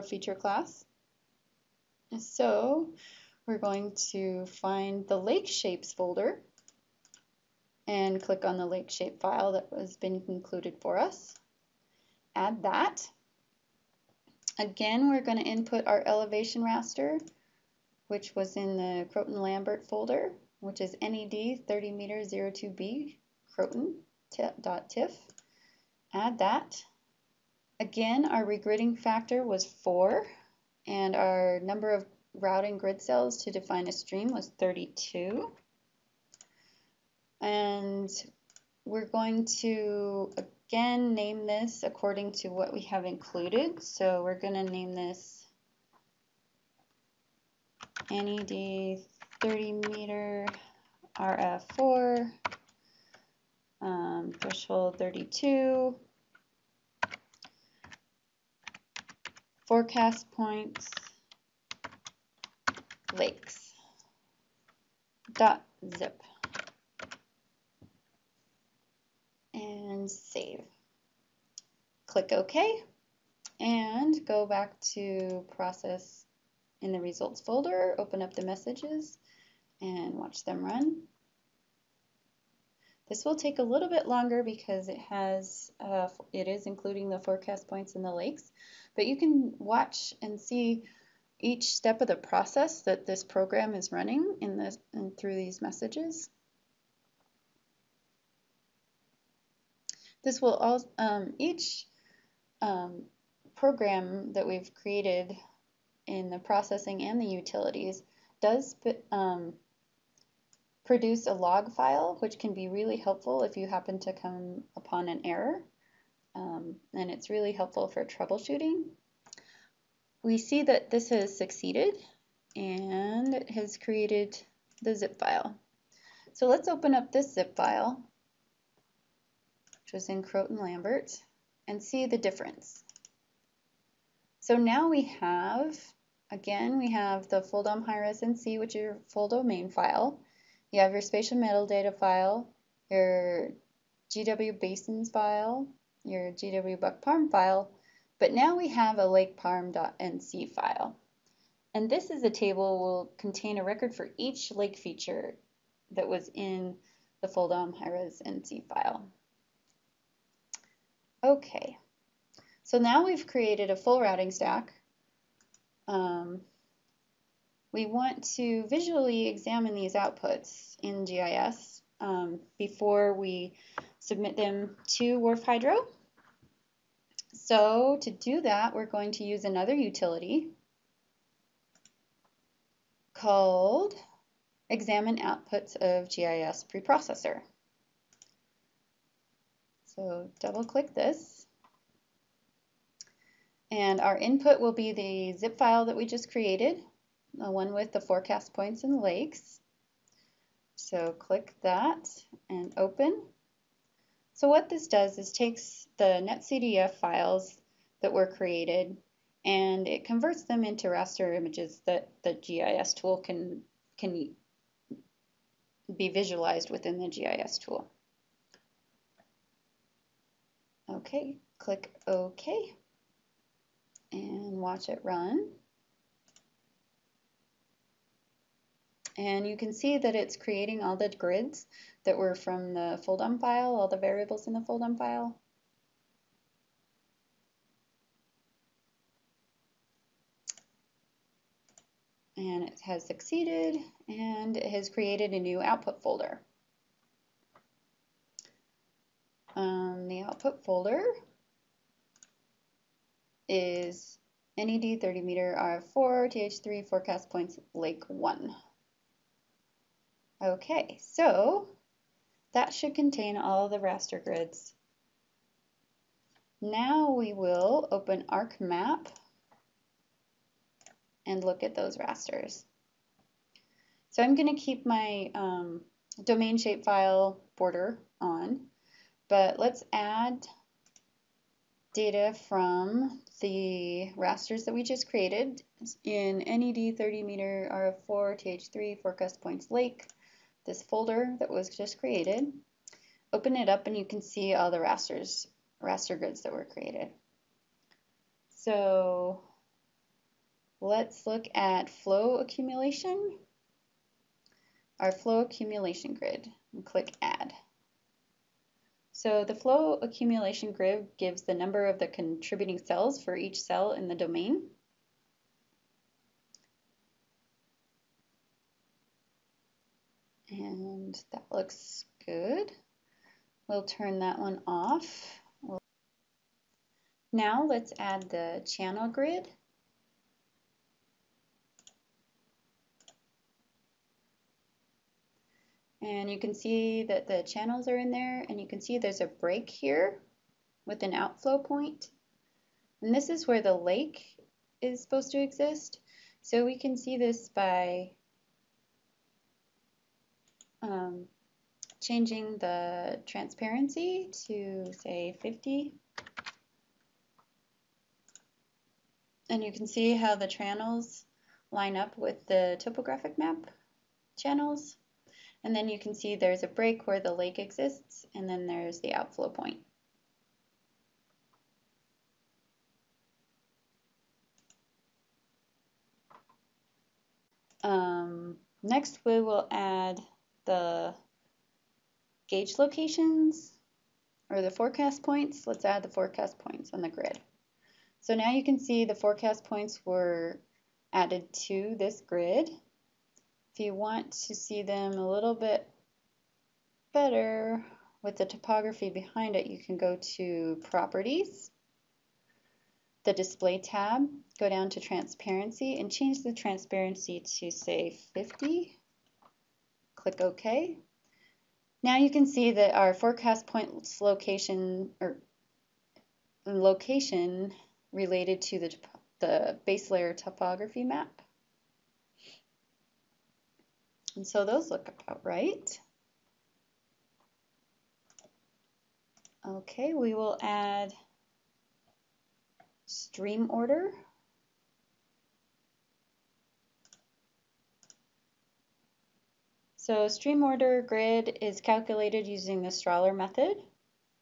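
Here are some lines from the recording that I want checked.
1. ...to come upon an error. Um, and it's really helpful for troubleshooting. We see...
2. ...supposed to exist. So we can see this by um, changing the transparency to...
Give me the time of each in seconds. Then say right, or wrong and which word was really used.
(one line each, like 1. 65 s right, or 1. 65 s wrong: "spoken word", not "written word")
1. 113 s right
2. 345 s right.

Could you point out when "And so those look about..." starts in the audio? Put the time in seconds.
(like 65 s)
424 s.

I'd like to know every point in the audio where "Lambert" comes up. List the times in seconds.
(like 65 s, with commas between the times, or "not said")
19 s, 130 s.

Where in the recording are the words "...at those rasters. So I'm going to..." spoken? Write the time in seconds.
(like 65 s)
271 s.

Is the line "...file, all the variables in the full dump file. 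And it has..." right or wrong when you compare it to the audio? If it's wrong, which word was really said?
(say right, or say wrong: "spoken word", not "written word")
right.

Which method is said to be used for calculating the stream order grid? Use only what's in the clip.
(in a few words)
Strahler method.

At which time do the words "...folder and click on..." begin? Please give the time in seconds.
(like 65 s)
5 s.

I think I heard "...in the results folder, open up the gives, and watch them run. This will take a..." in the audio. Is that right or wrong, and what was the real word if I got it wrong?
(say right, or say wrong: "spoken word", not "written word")
wrong: "messages", not "gives".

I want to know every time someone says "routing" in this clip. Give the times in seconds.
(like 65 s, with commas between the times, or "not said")
32 s, 163 s.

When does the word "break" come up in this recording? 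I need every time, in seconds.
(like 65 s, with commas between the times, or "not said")
339 s, 366 s.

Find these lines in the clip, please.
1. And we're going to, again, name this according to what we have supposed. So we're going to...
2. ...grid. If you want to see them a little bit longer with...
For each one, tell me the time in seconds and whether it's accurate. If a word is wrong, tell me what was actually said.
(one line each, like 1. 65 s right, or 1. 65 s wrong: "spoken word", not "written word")
1. 37 s wrong: "included", not "supposed"
2. 392 s wrong: "better", not "longer".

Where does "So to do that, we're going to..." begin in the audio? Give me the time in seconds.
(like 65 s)
177 s.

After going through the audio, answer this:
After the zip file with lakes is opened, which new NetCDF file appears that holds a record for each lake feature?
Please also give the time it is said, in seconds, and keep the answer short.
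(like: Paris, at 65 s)
lakeparm.nc, at 149 s.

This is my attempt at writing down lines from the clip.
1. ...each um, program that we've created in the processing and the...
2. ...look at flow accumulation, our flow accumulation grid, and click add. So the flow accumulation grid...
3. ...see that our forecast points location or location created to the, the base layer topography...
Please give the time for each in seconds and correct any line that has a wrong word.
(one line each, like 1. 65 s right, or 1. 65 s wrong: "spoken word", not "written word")
1. 101 s right
2. 301 s right
3. 412 s wrong: "related", not "created".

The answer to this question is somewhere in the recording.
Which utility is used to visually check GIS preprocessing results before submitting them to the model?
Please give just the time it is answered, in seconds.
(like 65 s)
184 s.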